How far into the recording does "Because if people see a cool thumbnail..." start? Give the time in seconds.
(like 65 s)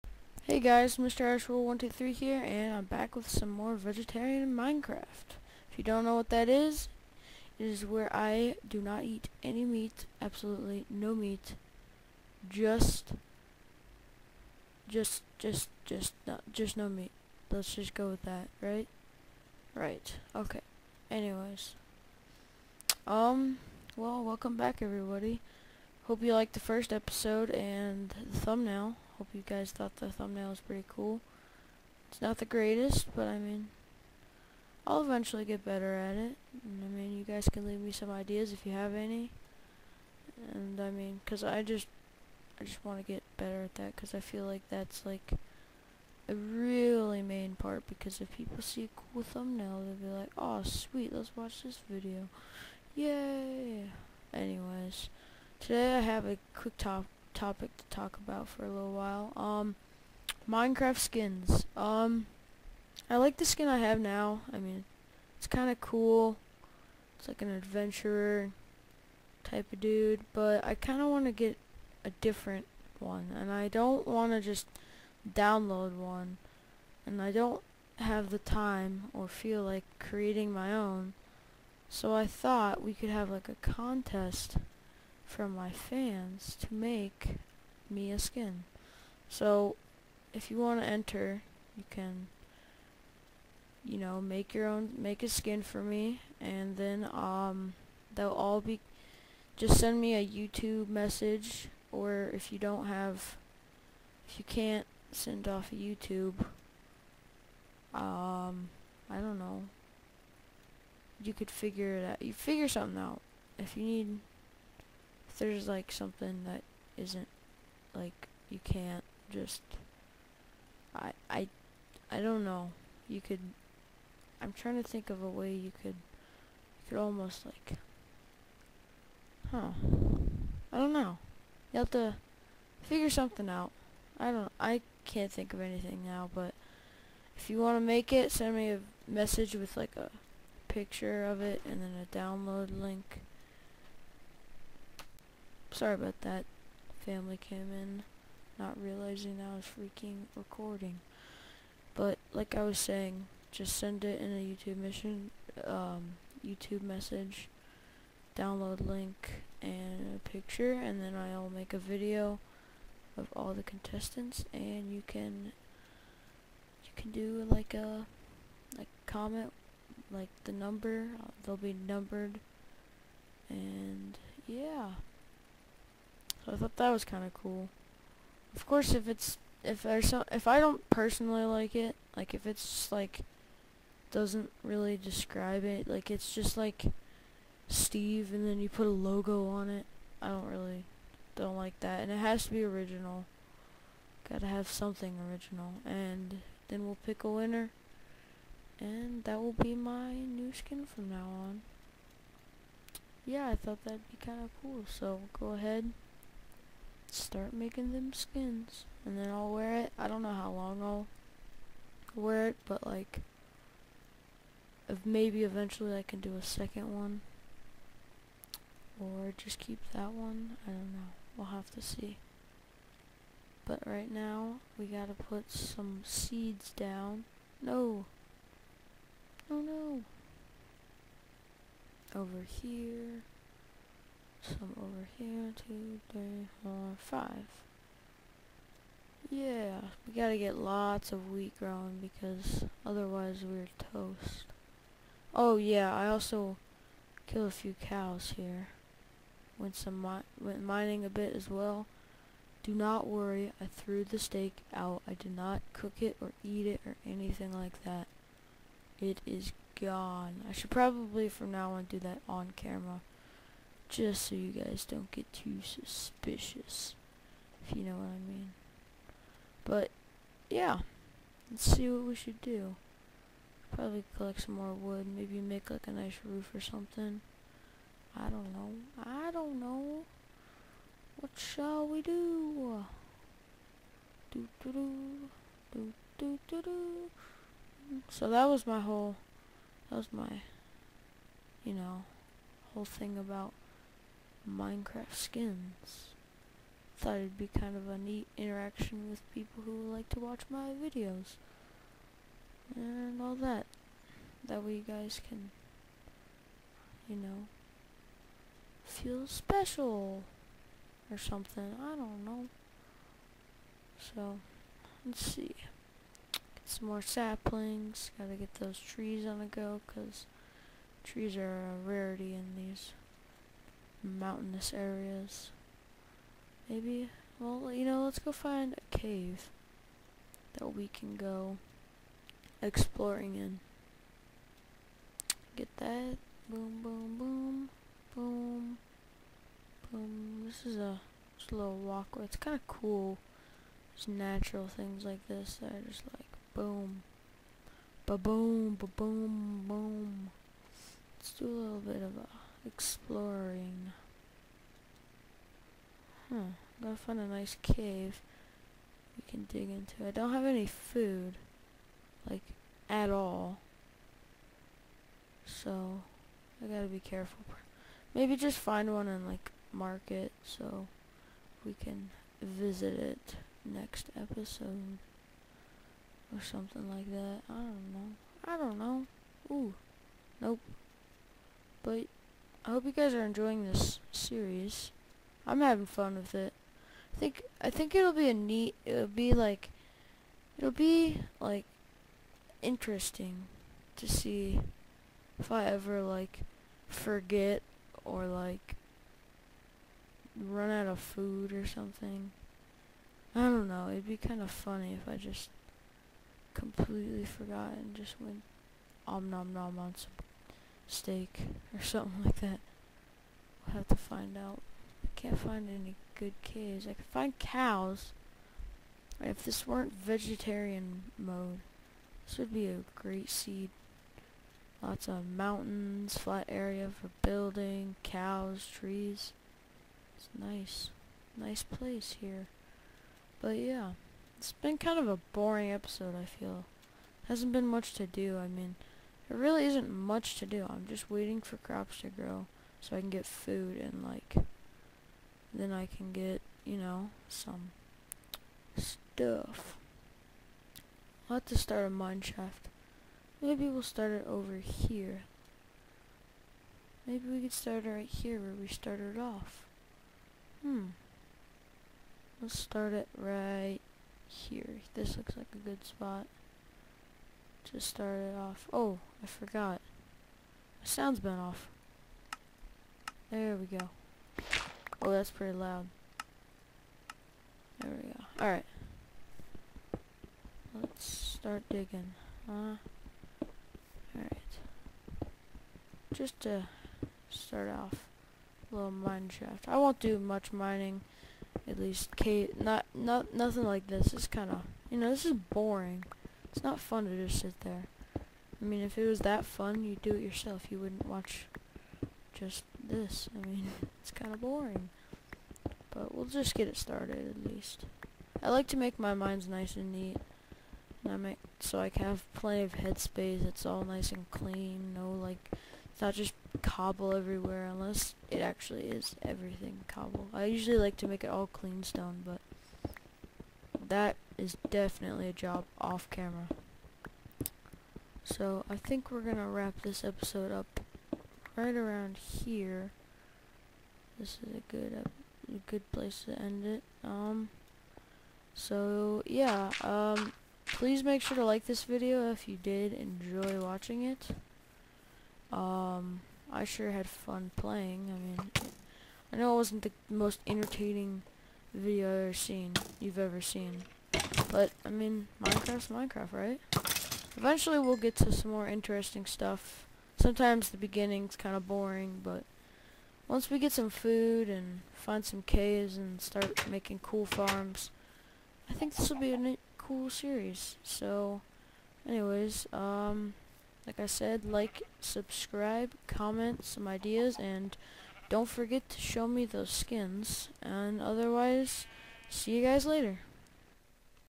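47 s.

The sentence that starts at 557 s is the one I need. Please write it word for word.
Eventually we'll get to some more interesting stuff.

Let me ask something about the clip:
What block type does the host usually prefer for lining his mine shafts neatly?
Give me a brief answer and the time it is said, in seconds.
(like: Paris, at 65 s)
clean stone, at 521 s.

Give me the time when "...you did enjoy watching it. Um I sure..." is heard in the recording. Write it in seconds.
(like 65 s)
542 s.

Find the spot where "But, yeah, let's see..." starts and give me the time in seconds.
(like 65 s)
269 s.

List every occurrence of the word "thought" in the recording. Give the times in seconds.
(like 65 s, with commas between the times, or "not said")
29 s, 82 s, 176 s, 203 s, 296 s.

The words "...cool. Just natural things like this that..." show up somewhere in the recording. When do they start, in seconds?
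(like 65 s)
342 s.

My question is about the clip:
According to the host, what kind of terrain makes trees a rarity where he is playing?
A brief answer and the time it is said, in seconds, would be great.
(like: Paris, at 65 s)
mountainous areas, at 324 s.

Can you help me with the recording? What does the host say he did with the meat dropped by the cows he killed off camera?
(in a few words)
threw the steak out.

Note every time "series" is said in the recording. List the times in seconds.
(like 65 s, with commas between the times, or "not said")
384 s, 570 s.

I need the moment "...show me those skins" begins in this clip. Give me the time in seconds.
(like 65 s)
578 s.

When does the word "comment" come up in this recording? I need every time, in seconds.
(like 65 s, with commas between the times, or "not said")
169 s, 576 s.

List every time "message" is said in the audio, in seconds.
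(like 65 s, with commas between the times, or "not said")
100 s, 139 s, 156 s.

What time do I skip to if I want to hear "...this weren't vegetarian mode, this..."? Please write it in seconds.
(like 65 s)
419 s.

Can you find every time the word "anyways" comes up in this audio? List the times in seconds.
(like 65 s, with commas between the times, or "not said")
21 s, 54 s, 572 s.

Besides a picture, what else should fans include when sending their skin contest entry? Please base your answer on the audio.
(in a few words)
a download link.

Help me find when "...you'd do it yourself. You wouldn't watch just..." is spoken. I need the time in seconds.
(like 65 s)
499 s.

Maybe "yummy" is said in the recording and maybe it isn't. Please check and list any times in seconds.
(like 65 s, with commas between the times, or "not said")
not said.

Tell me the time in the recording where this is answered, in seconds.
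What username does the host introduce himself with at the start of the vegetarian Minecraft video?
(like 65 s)
0 s.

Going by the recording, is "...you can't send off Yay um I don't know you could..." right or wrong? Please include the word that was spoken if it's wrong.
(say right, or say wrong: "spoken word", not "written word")
wrong: "YouTube", not "Yay".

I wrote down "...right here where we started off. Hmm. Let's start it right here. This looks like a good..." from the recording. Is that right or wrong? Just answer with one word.
right.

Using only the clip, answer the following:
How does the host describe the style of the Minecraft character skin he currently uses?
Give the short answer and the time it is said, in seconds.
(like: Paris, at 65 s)
adventurer type of dude, at 67 s.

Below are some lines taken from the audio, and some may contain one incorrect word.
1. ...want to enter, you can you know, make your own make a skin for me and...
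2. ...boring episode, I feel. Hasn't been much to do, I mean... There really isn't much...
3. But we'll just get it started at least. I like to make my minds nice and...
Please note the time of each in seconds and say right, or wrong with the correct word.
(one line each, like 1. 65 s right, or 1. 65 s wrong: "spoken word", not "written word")
1. 90 s right
2. 435 s right
3. 505 s right.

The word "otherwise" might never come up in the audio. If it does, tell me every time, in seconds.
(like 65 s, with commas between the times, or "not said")
242 s, 581 s.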